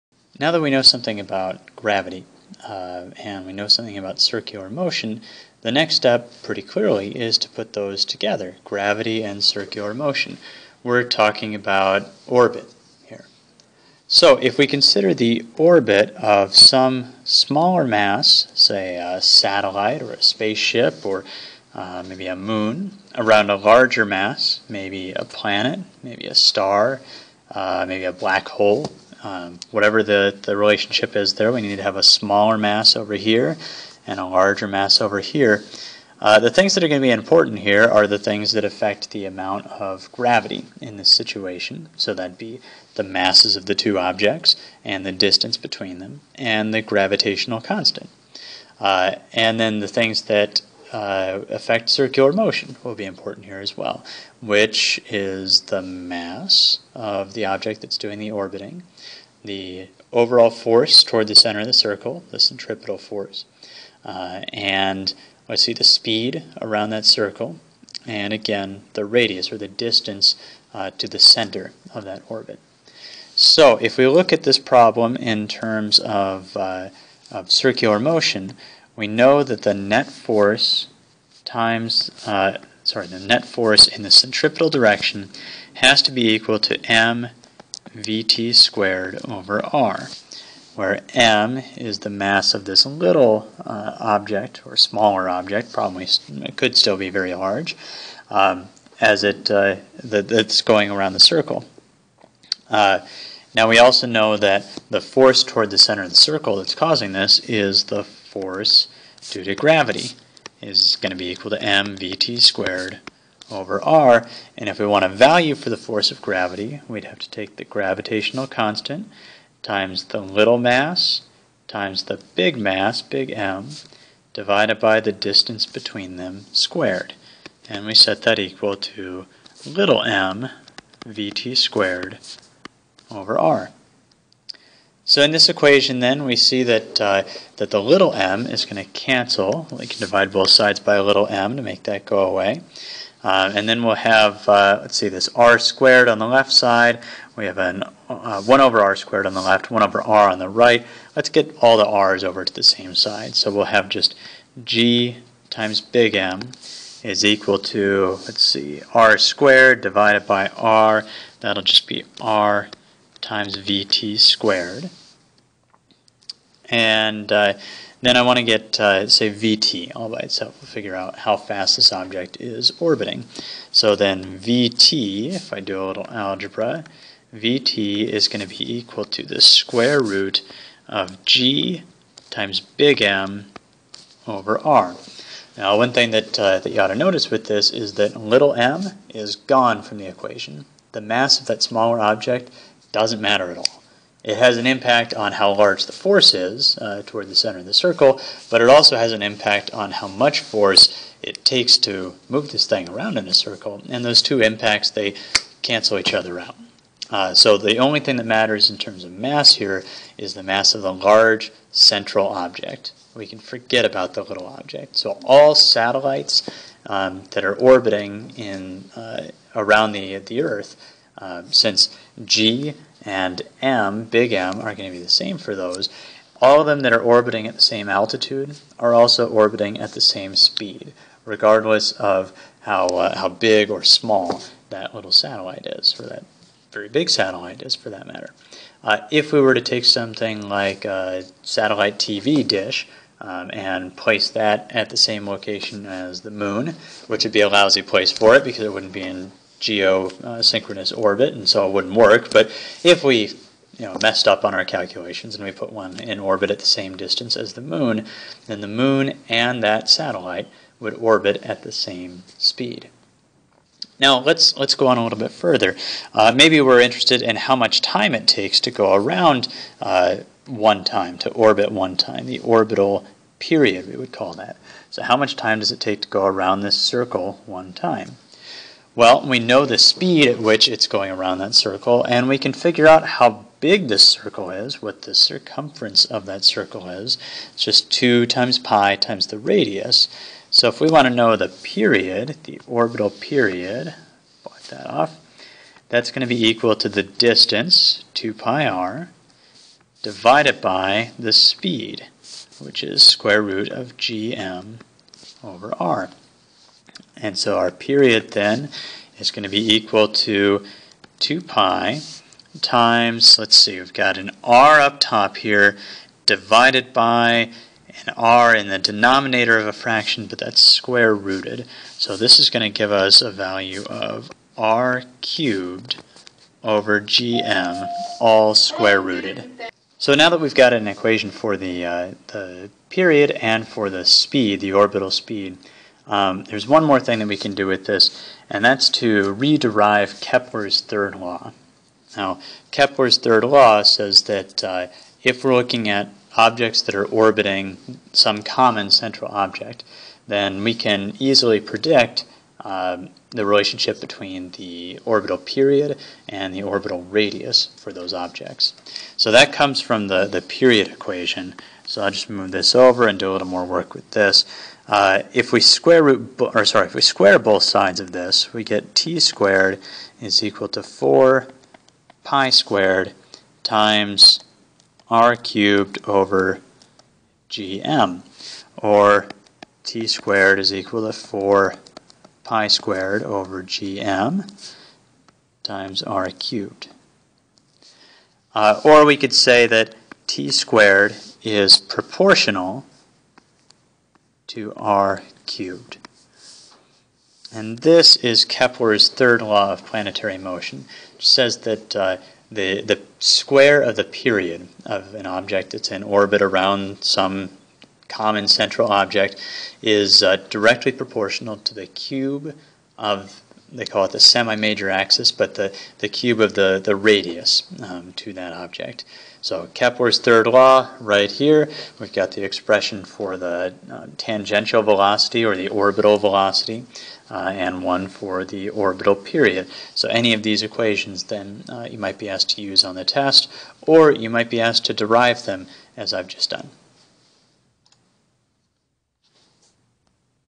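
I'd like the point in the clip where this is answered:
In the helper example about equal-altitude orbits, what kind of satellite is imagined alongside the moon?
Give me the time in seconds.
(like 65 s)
241 s.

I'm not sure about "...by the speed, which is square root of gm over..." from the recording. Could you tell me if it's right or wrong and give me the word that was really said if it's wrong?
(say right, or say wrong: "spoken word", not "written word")
right.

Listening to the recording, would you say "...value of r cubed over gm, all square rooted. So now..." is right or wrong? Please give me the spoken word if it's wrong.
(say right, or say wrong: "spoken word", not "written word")
right.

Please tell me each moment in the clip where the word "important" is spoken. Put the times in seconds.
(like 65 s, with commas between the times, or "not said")
37 s, 53 s.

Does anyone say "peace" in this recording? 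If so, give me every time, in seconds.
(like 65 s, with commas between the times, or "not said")
not said.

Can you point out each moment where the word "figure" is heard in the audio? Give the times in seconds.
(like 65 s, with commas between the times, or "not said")
170 s, 282 s.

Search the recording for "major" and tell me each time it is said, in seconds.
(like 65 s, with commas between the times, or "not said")
414 s.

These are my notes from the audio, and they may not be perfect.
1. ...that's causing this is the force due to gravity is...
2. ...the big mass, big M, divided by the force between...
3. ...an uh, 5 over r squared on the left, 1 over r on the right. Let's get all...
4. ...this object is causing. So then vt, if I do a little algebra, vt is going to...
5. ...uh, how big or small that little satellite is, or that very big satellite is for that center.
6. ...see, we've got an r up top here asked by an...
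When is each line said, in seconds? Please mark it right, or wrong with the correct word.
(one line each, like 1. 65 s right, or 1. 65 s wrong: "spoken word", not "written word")
1. 106 s right
2. 122 s wrong: "distance", not "force"
3. 147 s wrong: "1", not "5"
4. 171 s wrong: "orbiting", not "causing"
5. 232 s wrong: "matter", not "center"
6. 313 s wrong: "divided", not "asked".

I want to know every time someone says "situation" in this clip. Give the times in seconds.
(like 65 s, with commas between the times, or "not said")
41 s.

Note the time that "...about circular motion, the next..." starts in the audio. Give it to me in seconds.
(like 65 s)
3 s.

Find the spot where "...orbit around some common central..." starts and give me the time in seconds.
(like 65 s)
406 s.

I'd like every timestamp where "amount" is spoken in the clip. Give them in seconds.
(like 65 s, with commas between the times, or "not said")
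39 s.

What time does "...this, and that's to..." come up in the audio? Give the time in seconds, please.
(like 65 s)
337 s.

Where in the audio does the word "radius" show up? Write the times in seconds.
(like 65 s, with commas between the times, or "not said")
69 s, 289 s, 357 s, 416 s.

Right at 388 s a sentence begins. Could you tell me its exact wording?
Uh, or we could say that t squared is proportional to r cubed.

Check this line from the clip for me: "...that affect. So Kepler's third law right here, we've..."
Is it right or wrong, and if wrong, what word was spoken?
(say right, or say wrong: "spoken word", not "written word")
wrong: "object", not "affect".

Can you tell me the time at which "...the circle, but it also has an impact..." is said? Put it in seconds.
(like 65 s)
197 s.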